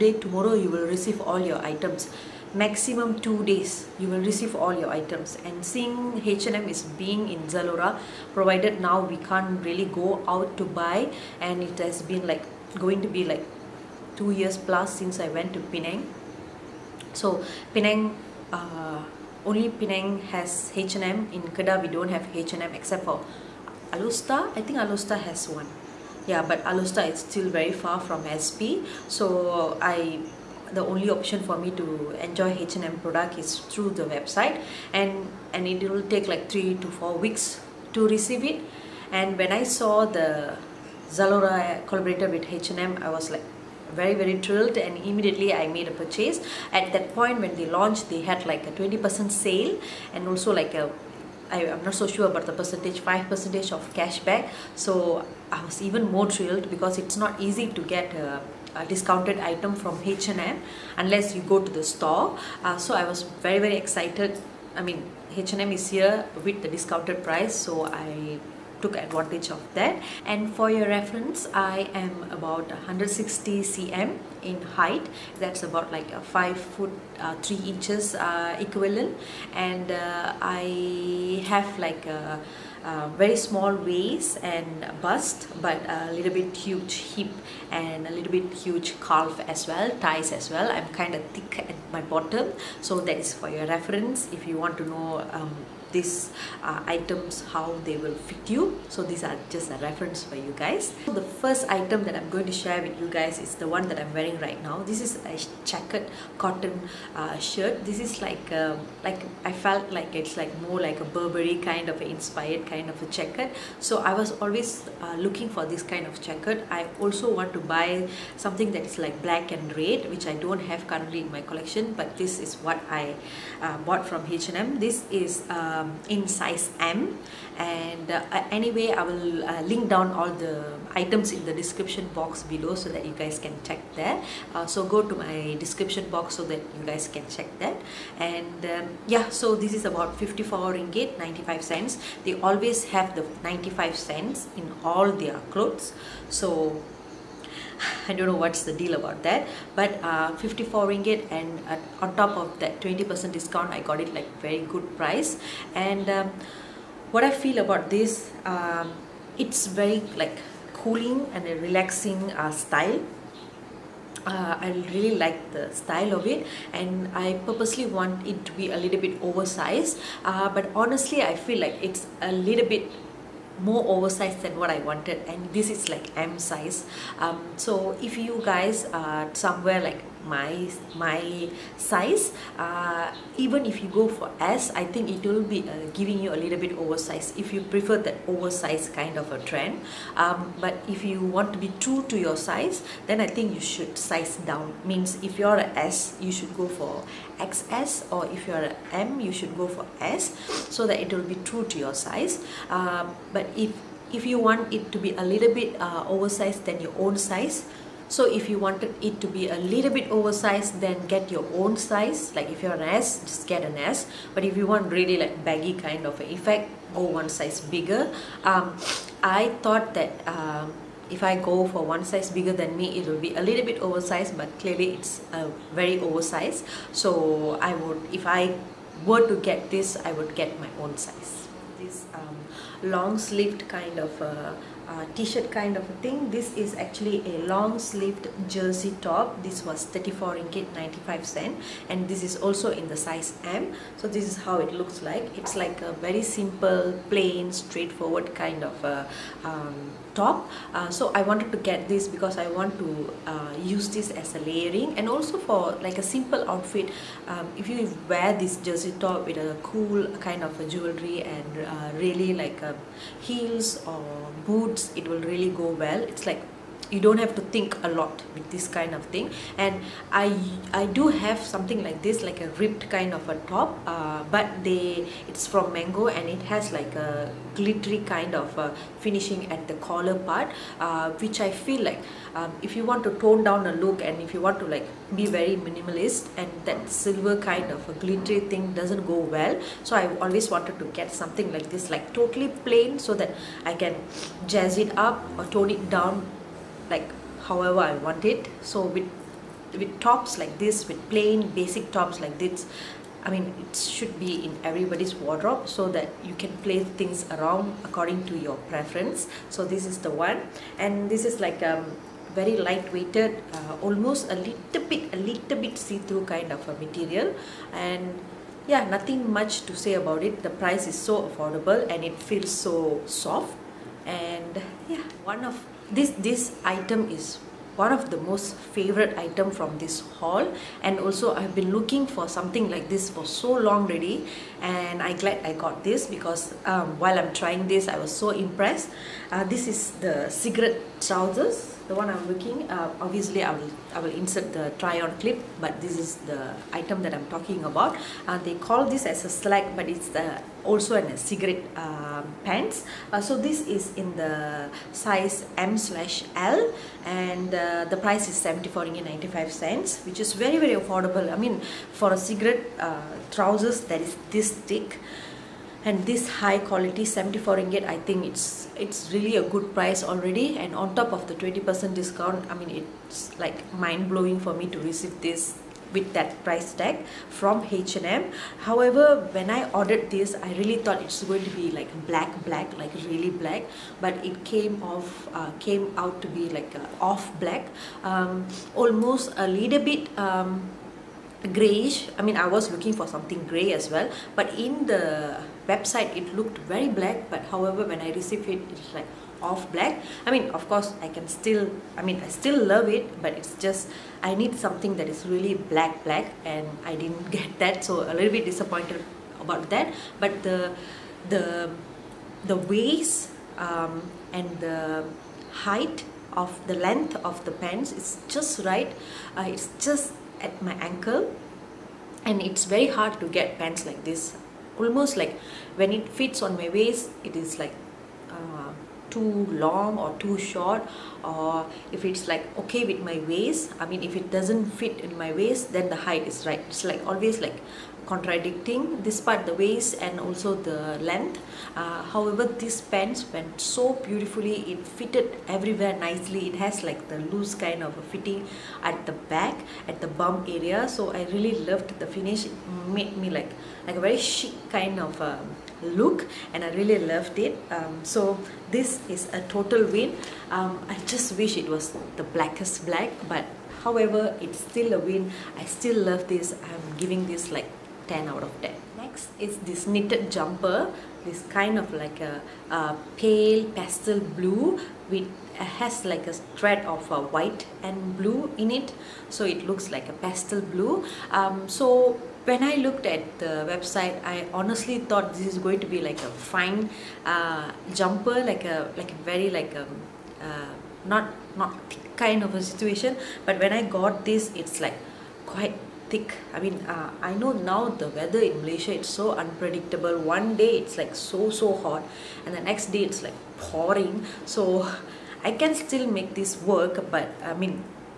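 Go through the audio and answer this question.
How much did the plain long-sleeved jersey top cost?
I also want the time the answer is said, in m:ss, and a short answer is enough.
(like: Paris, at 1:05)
RM34.95, at 3:59.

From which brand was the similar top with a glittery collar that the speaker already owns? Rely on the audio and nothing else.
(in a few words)
Mango.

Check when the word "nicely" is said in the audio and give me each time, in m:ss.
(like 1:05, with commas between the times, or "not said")
7:25.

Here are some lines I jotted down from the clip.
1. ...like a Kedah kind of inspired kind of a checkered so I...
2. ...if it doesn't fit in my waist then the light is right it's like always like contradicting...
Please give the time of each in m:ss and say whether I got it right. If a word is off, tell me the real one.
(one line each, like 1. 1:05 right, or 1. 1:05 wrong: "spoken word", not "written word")
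1. 1:50 wrong: "Burberry", not "Kedah"
2. 7:14 wrong: "height", not "light".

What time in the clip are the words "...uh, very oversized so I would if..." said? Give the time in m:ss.
3:45.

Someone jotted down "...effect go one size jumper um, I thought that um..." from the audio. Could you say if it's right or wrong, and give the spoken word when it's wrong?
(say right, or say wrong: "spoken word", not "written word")
wrong: "bigger", not "jumper".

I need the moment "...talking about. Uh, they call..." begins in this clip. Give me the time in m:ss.
5:47.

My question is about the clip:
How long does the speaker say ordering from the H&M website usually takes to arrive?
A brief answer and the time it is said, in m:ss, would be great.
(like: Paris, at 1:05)
3 to 4 weeks, at 0:36.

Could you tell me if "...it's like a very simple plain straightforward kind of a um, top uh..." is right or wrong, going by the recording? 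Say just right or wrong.
right.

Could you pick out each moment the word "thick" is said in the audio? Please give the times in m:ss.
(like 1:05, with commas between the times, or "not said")
1:31, 6:04, 8:11, 8:16.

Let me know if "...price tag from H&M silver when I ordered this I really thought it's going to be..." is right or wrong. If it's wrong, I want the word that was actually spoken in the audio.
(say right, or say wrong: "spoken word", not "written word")
wrong: "however", not "silver".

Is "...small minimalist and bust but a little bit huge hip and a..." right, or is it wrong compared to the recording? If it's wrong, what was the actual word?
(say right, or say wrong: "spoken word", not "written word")
wrong: "waist", not "minimalist".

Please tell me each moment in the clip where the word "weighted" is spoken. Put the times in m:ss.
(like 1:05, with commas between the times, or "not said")
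5:12.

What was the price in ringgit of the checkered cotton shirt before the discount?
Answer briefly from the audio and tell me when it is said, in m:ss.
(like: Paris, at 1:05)
RM54.95, at 2:20.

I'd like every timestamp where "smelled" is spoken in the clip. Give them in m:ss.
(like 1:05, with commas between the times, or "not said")
not said.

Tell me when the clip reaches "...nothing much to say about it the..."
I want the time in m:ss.
5:18.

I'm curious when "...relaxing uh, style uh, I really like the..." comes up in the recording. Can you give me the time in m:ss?
2:41.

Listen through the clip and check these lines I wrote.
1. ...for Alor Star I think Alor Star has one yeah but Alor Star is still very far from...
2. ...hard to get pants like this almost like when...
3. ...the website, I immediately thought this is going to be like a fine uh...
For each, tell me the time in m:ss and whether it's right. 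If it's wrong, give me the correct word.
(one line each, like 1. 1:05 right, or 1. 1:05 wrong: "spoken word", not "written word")
1. 0:23 right
2. 7:02 right
3. 8:03 wrong: "honestly", not "immediately".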